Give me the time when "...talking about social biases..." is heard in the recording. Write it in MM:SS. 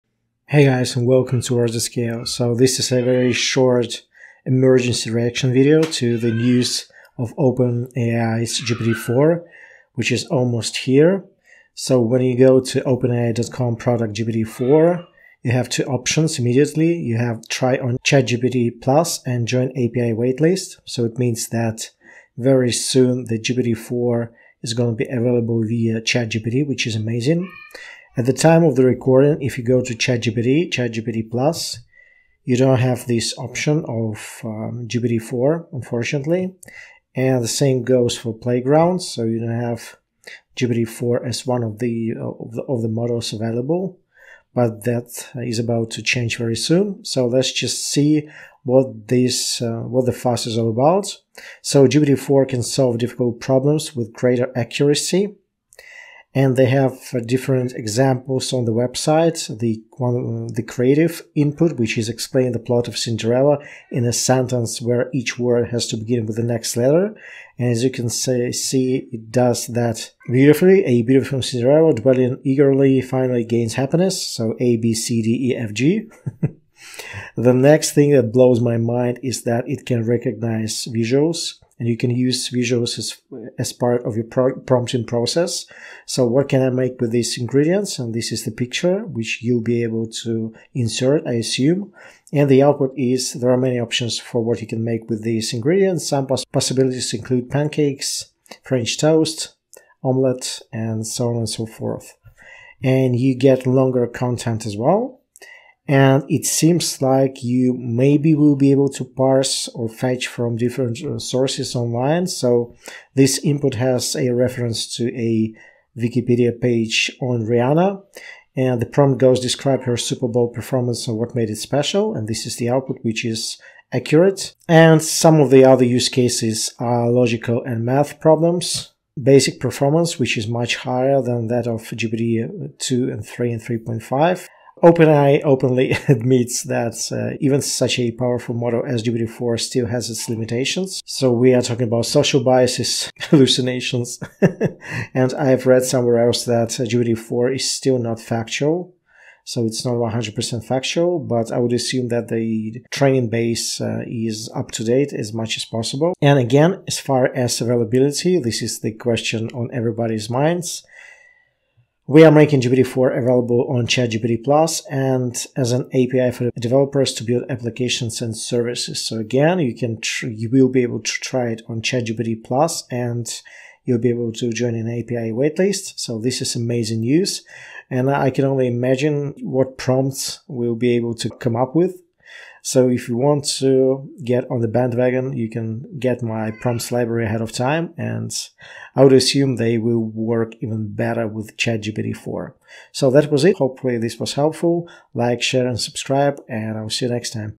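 02:21.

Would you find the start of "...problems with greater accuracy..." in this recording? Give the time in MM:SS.
00:53.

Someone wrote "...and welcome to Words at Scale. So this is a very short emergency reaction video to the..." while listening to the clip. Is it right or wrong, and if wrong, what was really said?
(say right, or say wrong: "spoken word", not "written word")
right.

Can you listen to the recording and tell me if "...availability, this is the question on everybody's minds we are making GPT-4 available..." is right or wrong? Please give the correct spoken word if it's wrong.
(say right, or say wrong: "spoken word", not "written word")
right.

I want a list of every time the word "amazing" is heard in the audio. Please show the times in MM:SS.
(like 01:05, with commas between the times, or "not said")
00:26, 02:56.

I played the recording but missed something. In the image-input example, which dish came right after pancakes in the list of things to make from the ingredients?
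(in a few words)
French toast.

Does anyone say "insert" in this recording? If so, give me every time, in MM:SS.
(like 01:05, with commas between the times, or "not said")
01:30.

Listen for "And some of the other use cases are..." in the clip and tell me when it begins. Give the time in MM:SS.
02:04.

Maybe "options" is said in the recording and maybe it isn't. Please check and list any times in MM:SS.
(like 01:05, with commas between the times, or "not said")
00:15, 00:33, 01:33.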